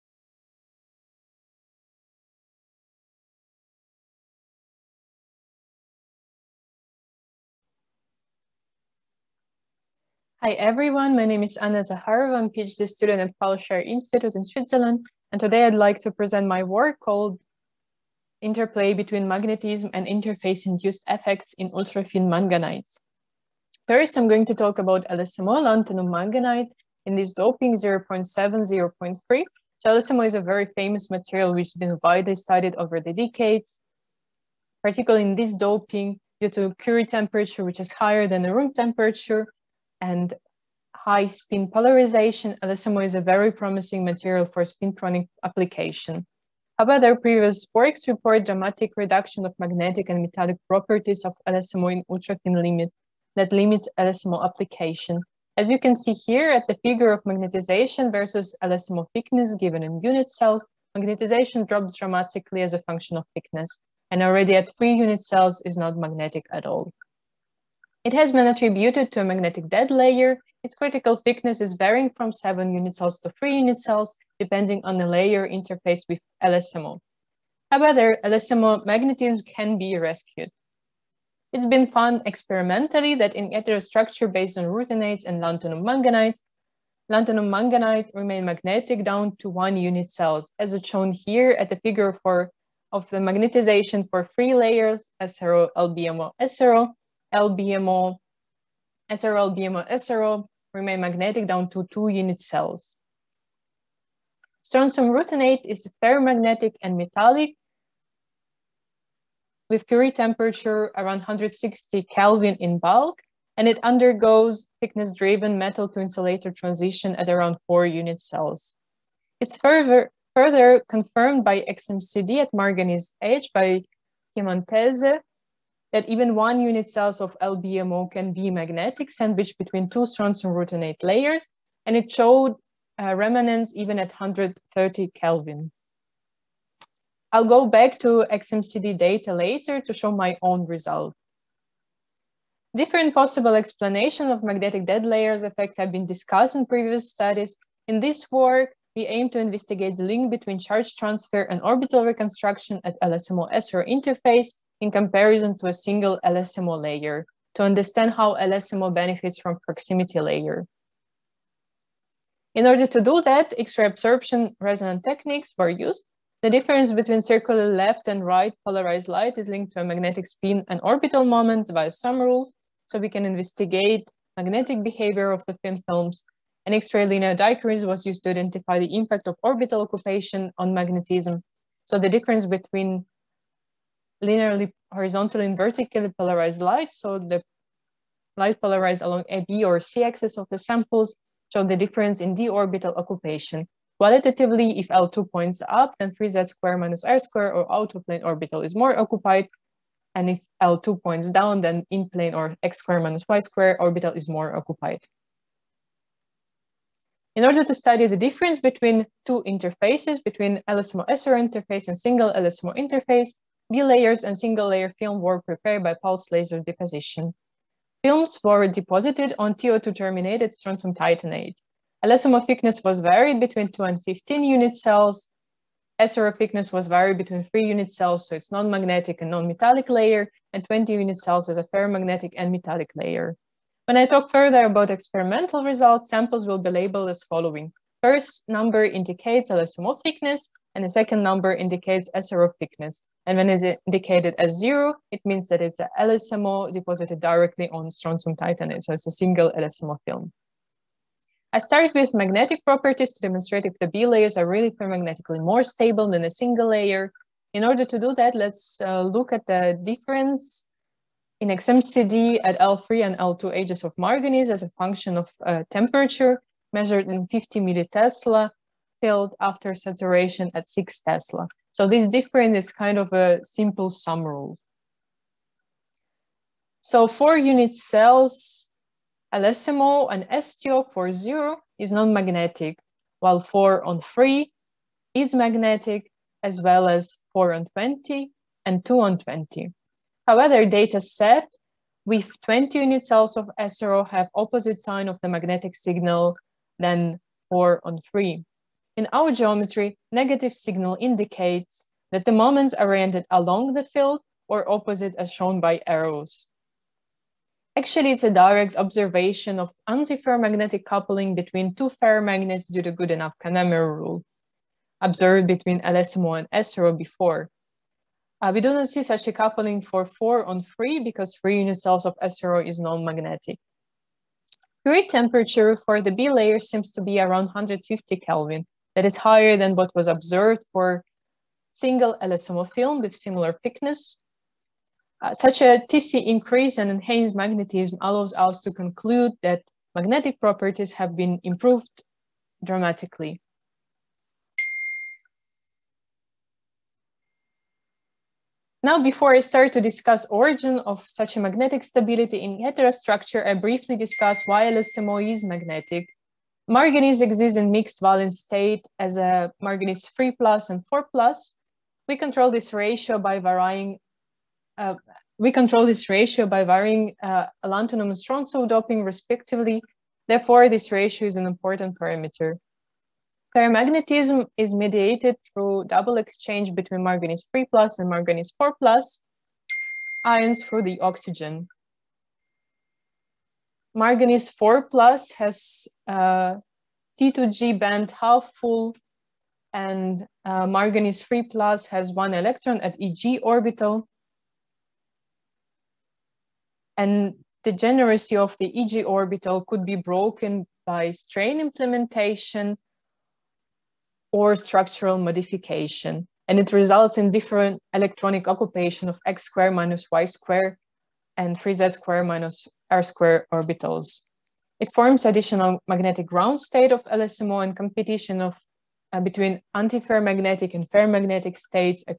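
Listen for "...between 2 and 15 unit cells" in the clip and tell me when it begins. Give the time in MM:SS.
03:43.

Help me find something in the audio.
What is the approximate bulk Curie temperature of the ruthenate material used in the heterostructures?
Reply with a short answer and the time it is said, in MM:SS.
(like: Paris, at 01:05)
160 Kelvin, at 01:51.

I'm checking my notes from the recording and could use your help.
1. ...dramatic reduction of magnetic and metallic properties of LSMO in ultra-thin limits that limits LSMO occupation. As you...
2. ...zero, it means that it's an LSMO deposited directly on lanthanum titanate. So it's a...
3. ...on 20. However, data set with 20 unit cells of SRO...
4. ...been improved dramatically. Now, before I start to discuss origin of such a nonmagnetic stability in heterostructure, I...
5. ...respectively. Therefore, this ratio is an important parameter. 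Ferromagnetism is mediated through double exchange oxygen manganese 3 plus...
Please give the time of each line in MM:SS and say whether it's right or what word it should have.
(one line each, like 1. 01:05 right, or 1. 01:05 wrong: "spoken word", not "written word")
1. 00:48 wrong: "application", not "occupation"
2. 04:04 wrong: "strontium", not "lanthanum"
3. 04:48 right
4. 05:41 wrong: "magnetic", not "nonmagnetic"
5. 06:09 wrong: "between", not "oxygen".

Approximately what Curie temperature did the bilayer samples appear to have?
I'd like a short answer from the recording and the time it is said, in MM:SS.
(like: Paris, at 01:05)
150 Kelvin, at 05:27.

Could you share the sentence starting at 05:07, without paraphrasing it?
Actually, it's a direct observation of antiferromagnetic coupling between two ferromagnets due to Goodenough Kanamori rule, observed between LSMO and SRO before.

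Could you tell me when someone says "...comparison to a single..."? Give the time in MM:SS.
02:34.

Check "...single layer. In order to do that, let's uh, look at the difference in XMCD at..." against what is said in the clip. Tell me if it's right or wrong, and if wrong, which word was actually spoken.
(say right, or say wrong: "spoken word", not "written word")
right.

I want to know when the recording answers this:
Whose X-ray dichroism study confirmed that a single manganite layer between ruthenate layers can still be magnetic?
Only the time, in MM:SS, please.
02:04.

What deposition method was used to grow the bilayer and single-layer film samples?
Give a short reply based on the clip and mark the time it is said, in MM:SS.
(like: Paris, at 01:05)
pulse laser deposition, at 03:35.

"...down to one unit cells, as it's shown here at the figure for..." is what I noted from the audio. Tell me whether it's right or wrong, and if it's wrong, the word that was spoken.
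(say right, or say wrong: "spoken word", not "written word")
right.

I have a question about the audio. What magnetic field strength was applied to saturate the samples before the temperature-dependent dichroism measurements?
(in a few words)
6 tesla.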